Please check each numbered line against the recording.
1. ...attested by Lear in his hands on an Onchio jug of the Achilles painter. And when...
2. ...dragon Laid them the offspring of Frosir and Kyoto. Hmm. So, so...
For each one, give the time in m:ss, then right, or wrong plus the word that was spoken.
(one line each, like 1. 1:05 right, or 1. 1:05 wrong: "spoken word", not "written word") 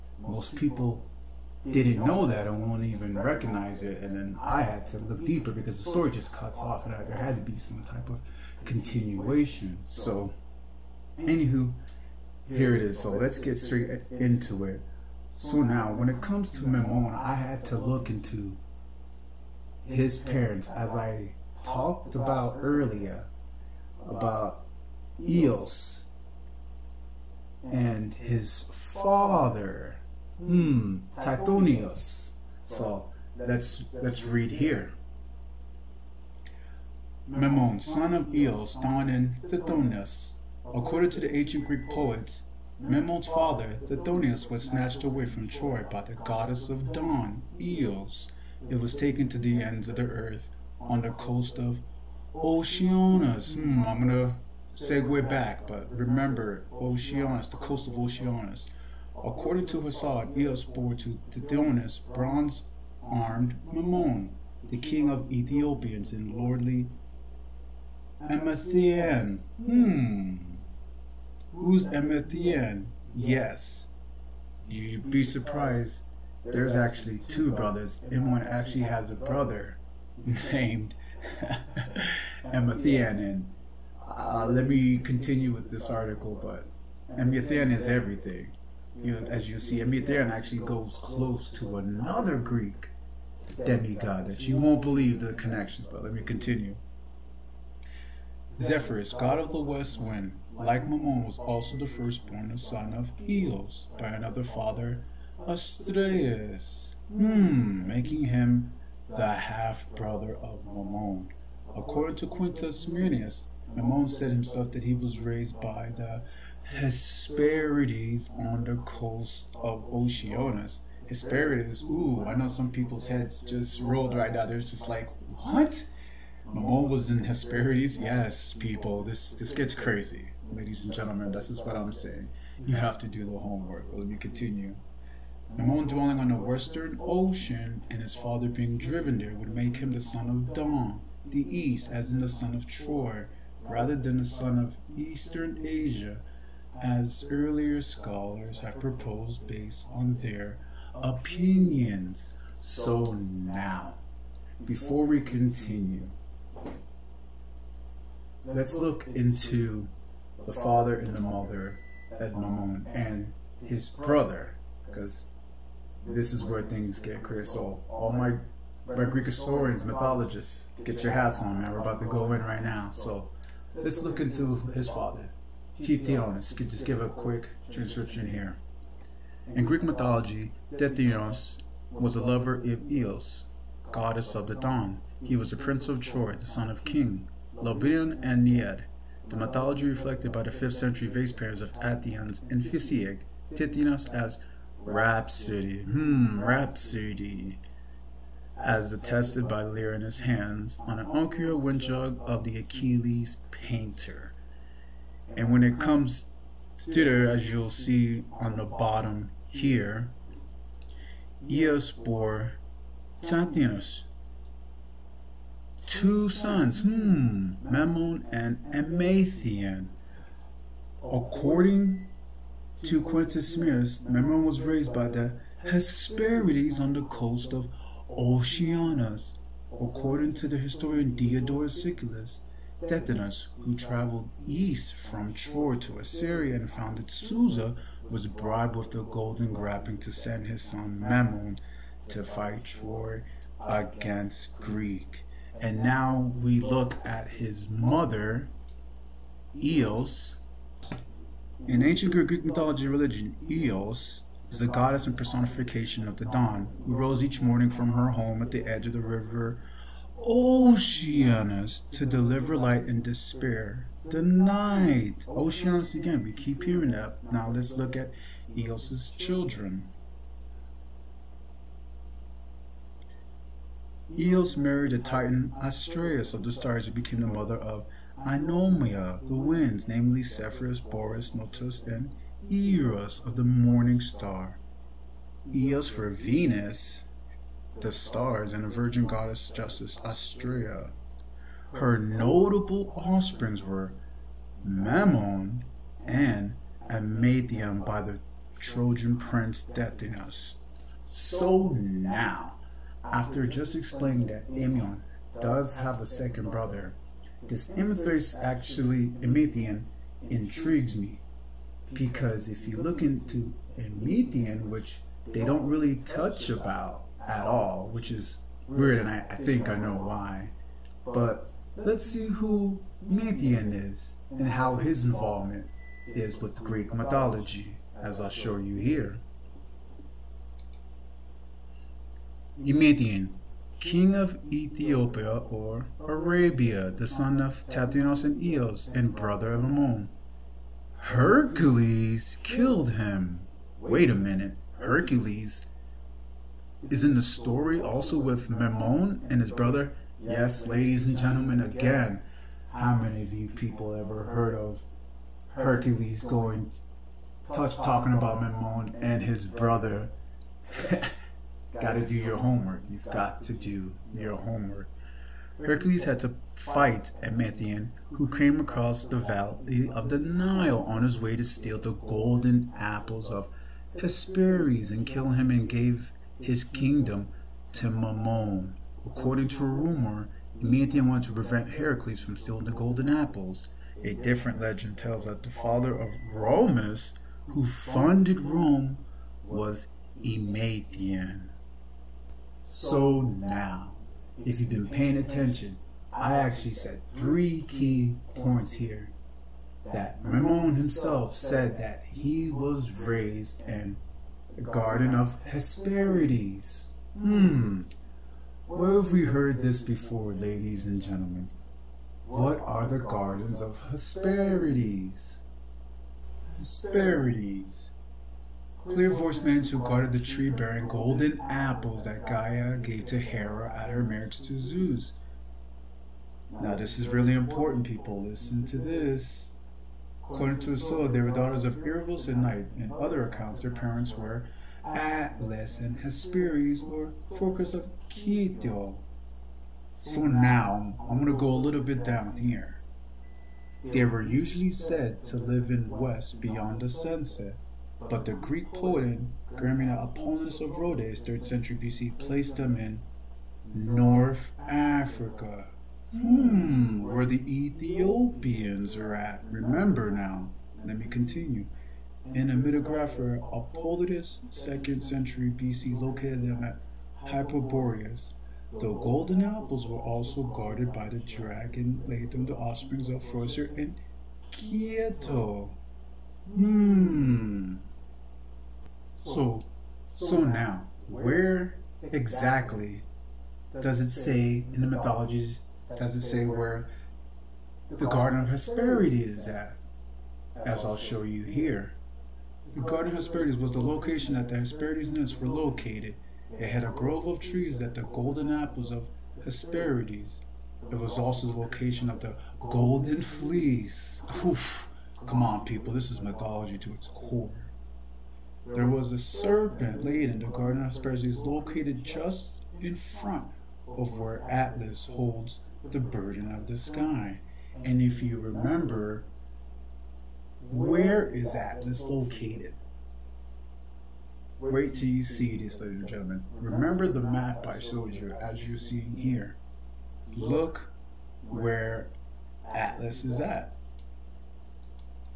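1. 3:18 right
2. 7:51 right.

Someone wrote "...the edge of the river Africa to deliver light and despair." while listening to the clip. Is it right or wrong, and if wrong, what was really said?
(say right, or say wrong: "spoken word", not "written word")
wrong: "Oceanus", not "Africa".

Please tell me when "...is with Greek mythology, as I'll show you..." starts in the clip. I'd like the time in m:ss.
5:26.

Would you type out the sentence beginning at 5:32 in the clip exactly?
Emathion, king of Ethiopia or Arabia, the son of Tithonus and Eos, and brother of Ammon.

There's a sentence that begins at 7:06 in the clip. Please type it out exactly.
Now, this is really important, people.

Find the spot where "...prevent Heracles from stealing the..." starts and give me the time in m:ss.
6:21.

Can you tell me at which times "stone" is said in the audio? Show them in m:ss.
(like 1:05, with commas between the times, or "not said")
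not said.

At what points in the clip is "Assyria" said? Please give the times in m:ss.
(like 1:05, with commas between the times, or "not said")
3:55.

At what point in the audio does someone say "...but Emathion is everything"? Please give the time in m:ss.
1:26.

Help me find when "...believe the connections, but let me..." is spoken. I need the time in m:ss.
1:34.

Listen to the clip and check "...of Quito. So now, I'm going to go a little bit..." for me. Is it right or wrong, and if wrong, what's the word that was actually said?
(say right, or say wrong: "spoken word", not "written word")
right.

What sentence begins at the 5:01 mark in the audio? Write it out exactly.
So now, after just explaining that Amion does have a second brother, this Amethyst actually, Emathion, intrigues me.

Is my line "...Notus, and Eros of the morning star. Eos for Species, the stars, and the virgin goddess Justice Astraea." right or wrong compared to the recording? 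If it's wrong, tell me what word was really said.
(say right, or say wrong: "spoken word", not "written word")
wrong: "Venus", not "Species".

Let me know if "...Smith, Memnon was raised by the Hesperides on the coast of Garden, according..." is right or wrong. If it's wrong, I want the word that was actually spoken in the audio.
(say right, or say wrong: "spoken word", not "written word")
wrong: "Oceanus", not "Garden".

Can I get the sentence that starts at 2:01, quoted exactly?
Hesperides, ooh, I know some people's heads just rolled right now.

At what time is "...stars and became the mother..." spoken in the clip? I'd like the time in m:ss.
4:36.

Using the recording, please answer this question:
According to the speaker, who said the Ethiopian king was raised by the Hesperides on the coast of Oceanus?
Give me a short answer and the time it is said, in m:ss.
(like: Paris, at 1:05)
Quintus Smyrnaeus, at 1:52.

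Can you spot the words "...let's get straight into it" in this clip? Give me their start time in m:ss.
0:13.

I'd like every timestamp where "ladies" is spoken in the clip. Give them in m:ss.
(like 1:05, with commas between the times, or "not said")
2:10, 5:50, 6:50, 8:45.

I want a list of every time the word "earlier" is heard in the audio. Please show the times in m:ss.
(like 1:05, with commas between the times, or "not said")
0:22, 2:27.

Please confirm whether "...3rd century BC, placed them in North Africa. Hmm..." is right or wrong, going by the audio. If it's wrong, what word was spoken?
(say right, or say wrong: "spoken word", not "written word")
right.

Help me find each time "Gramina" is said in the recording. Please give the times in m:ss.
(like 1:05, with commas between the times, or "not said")
7:29.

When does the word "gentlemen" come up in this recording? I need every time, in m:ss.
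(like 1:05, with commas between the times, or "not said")
2:10, 5:51, 6:50, 8:46.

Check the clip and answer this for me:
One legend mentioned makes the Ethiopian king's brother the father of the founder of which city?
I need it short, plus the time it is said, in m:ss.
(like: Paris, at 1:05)
Rome, at 6:28.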